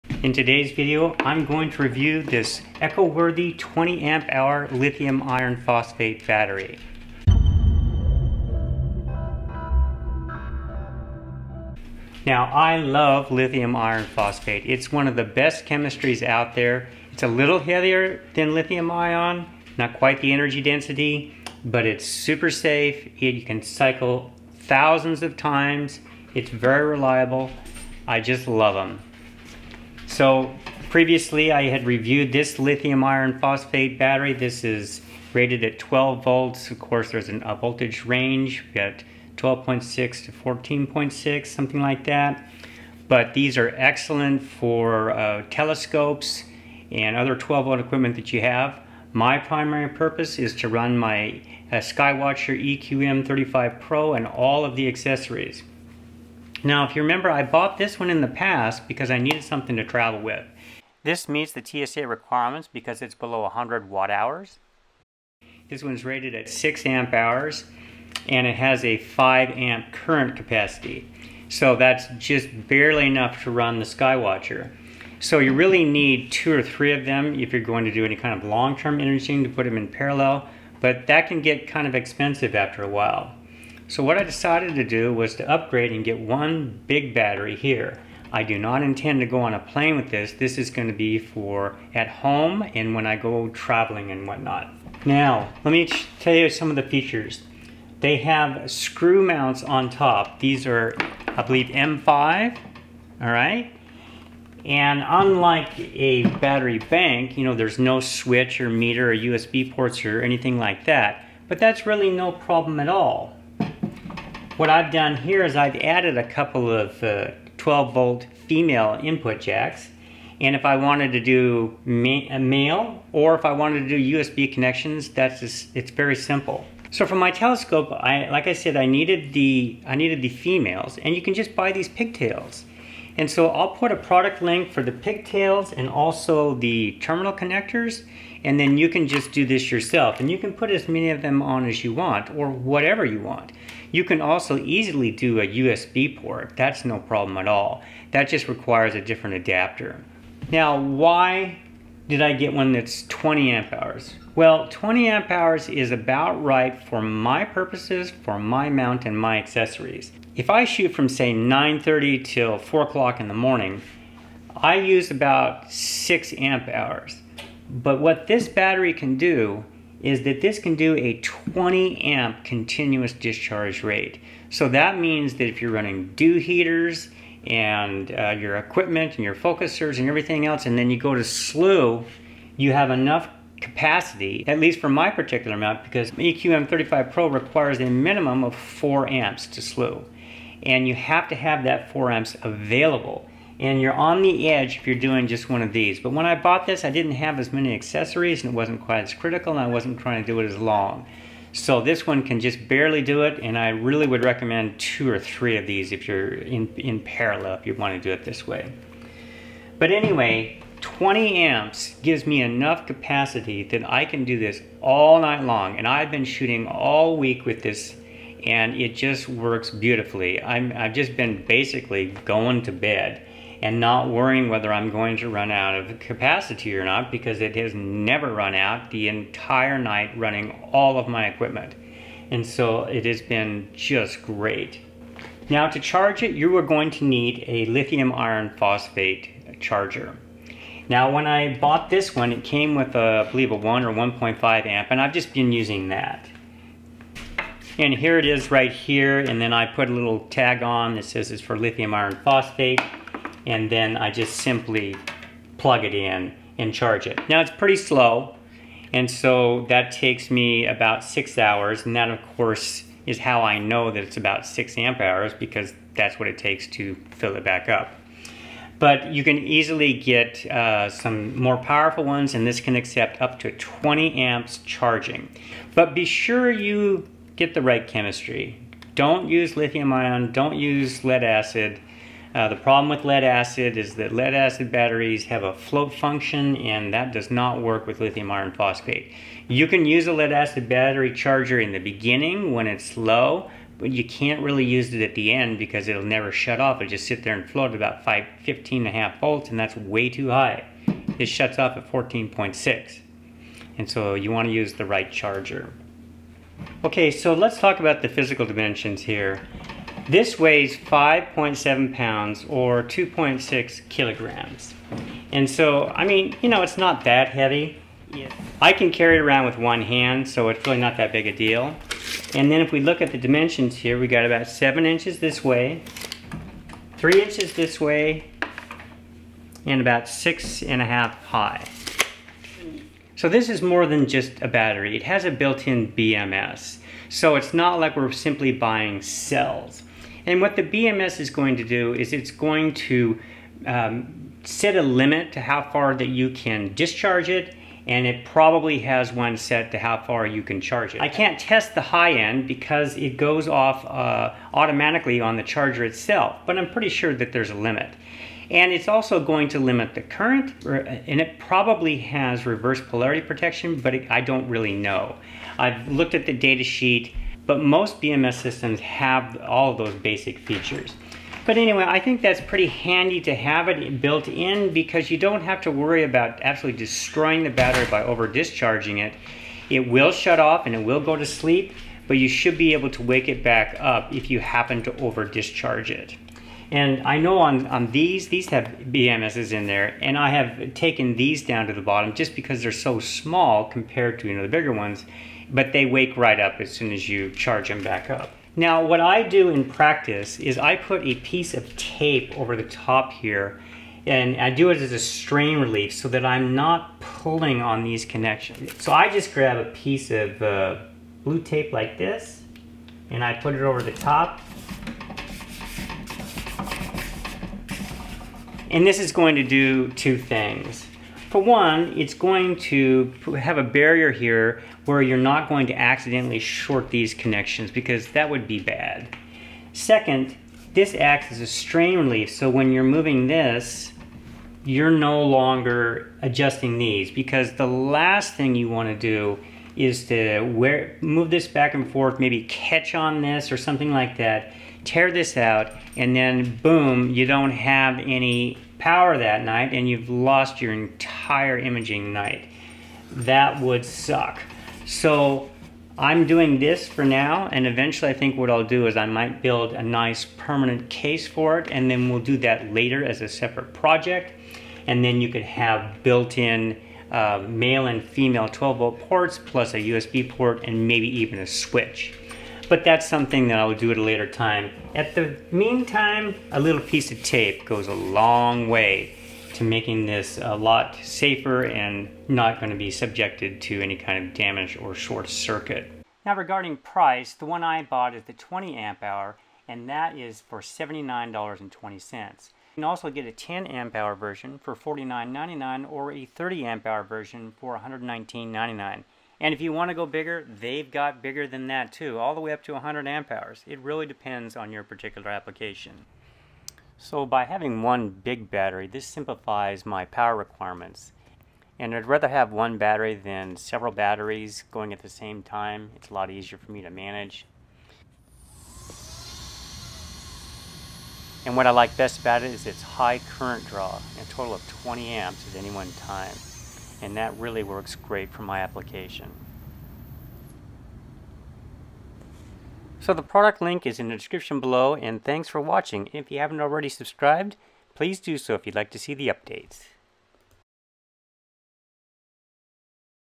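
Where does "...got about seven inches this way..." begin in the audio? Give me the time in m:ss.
5:24.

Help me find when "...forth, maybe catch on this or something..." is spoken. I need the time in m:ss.
7:21.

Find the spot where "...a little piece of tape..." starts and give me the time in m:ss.
7:56.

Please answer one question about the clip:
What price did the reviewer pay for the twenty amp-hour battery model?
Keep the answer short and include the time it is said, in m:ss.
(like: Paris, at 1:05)
$79.20, at 8:10.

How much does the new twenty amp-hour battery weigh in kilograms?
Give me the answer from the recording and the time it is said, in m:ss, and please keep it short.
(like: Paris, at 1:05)
2.6 kilograms, at 5:12.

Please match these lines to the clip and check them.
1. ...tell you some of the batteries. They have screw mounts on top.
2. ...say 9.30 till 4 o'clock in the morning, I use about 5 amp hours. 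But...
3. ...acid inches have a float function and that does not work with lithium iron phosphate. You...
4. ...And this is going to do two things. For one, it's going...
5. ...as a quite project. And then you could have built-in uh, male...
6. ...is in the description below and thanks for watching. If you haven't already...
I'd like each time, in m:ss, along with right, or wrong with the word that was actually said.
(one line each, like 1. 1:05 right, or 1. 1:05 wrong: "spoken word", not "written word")
1. 1:36 wrong: "features", not "batteries"
2. 2:41 wrong: "6", not "5"
3. 4:44 wrong: "batteries", not "inches"
4. 6:58 right
5. 7:43 wrong: "separate", not "quite"
6. 8:53 right.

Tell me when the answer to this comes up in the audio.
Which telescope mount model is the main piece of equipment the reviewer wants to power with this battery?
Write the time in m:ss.
0:51.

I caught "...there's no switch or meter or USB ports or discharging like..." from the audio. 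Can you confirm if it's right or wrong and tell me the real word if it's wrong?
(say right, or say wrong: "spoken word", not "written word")
wrong: "anything", not "discharging".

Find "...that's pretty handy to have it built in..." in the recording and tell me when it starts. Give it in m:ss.
6:12.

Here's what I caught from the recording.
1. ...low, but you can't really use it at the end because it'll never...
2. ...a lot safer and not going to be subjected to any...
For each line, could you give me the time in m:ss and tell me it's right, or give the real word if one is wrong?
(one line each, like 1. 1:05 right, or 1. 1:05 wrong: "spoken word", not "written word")
1. 4:52 right
2. 8:00 right.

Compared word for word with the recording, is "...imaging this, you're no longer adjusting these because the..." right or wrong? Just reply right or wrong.
wrong.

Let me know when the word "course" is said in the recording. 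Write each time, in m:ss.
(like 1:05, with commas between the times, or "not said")
0:36, 4:22.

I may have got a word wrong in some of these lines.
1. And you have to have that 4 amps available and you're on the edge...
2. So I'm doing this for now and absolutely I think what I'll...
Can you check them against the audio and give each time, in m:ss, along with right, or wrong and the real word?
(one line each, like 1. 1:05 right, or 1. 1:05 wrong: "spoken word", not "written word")
1. 3:10 right
2. 7:34 wrong: "eventually", not "absolutely".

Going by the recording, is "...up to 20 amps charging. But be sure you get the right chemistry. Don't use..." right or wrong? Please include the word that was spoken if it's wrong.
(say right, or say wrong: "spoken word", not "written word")
right.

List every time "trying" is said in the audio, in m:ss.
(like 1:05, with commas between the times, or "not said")
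3:19.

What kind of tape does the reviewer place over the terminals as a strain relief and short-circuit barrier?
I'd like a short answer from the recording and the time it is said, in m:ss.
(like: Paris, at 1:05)
blue tape, at 6:51.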